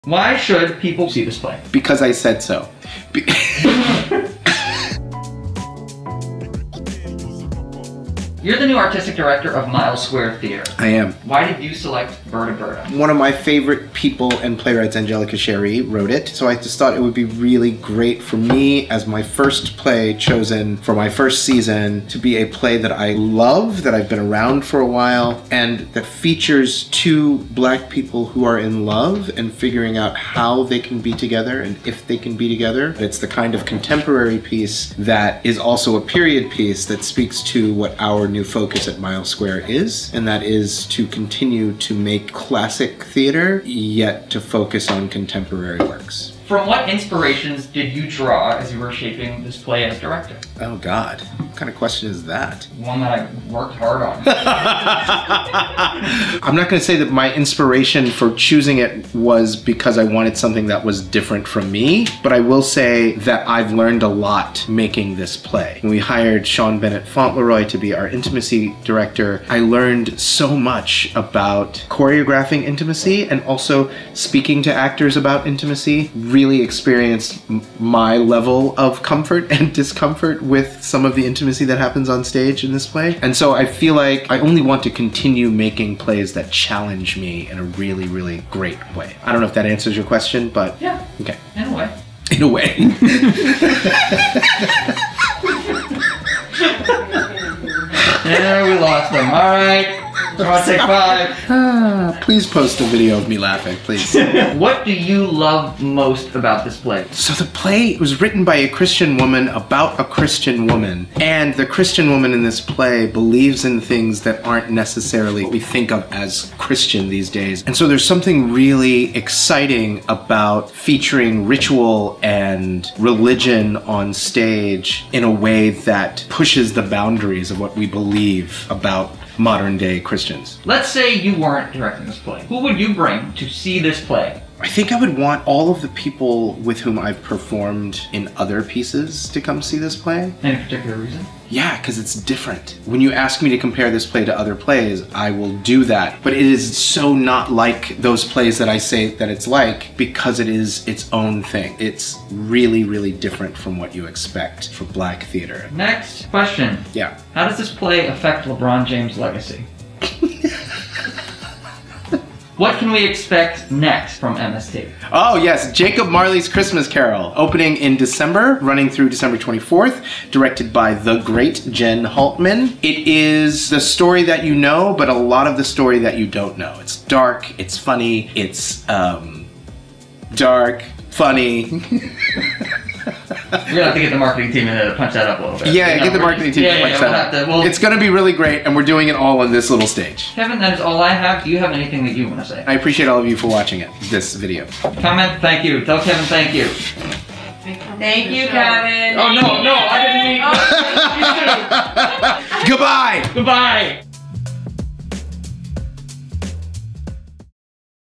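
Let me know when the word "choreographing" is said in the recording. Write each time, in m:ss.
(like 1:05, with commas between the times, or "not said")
1:11.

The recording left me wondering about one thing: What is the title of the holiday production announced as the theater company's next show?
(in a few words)
Jacob Marley's Christmas Carol.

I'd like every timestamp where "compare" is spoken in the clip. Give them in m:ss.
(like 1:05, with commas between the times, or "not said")
2:23.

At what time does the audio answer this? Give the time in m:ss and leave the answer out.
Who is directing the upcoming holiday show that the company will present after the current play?
2:51.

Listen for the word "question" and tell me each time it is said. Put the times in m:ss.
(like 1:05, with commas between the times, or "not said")
0:51, 1:30, 2:36.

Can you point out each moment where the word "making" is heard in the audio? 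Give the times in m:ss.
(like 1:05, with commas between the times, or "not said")
1:04, 1:25.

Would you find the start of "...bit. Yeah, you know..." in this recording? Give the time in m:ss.
3:05.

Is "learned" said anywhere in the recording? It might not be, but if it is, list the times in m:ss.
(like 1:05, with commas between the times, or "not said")
1:03, 1:09.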